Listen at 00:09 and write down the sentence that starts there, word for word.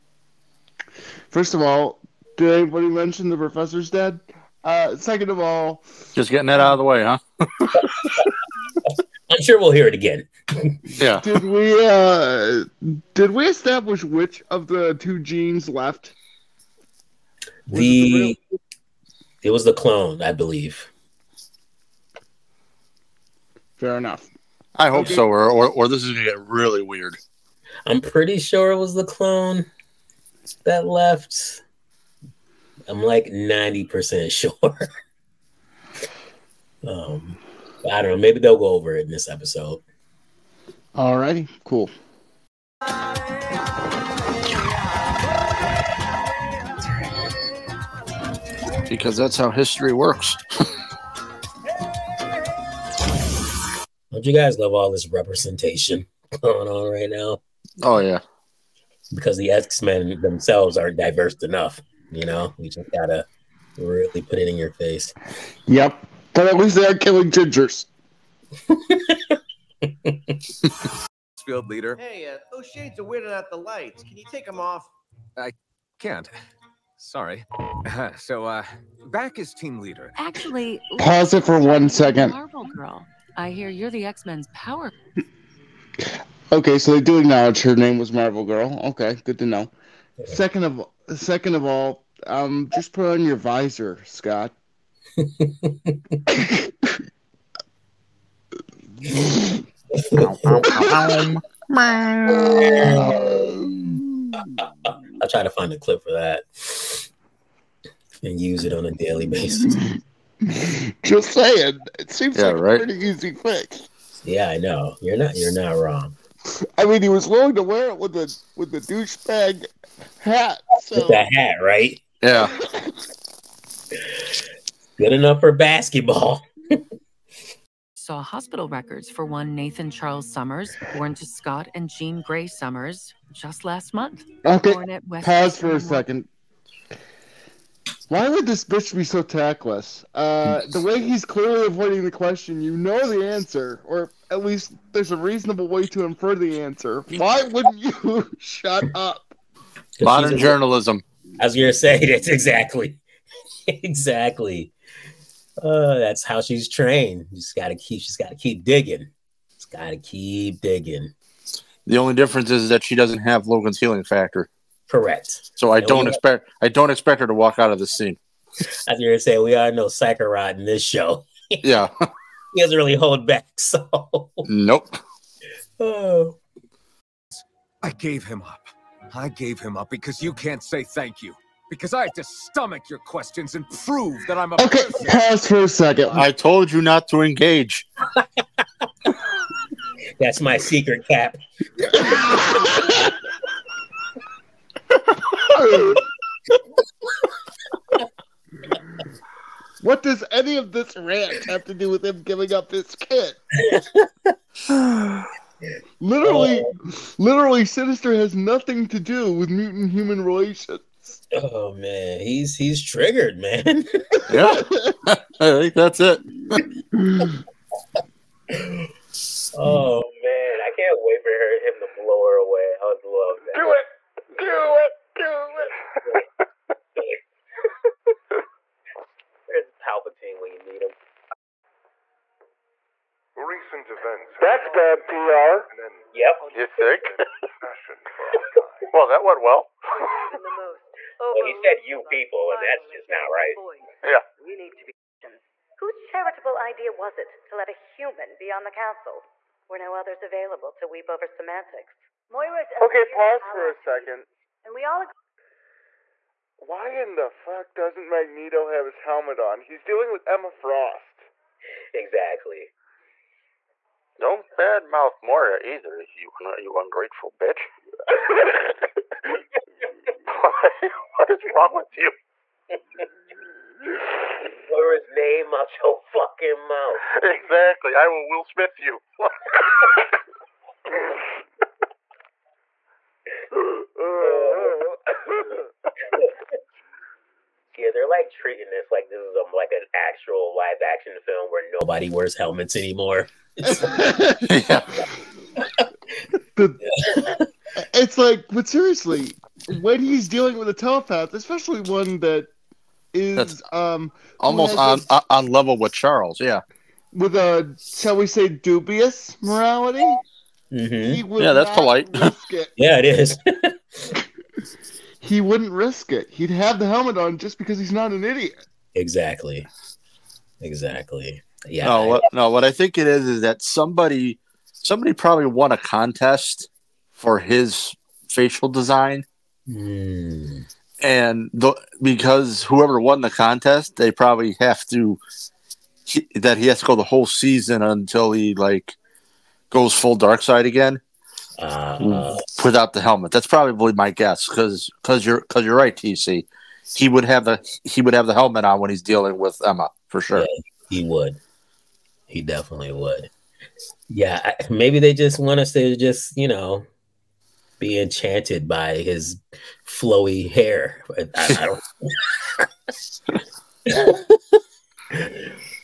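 I'm sure we'll hear it again.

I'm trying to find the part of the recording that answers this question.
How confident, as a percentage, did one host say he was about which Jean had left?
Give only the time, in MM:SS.
00:33.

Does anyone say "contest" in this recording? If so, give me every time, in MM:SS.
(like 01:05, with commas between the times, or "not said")
05:25, 05:33.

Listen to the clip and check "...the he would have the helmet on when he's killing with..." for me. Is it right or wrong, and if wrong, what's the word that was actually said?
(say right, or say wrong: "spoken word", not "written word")
wrong: "dealing", not "killing".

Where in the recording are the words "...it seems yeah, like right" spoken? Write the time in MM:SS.
01:51.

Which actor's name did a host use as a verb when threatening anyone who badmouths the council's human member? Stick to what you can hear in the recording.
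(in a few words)
Will Smith.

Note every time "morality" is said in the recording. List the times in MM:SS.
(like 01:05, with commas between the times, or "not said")
05:09.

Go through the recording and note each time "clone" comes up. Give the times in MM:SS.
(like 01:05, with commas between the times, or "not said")
00:19, 00:29.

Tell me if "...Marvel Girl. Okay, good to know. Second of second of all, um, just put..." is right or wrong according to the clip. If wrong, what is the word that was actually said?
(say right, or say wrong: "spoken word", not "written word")
right.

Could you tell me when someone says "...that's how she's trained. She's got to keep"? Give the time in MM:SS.
02:35.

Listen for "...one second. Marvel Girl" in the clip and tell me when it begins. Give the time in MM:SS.
01:21.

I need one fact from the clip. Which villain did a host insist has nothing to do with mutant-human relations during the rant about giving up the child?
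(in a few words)
Sinister.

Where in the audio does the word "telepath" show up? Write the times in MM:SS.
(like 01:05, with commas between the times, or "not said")
05:00.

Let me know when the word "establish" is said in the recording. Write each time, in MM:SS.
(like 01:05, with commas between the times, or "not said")
00:13.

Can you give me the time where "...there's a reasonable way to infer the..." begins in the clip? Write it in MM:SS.
02:24.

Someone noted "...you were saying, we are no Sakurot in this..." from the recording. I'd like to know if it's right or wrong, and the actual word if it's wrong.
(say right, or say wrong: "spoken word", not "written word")
right.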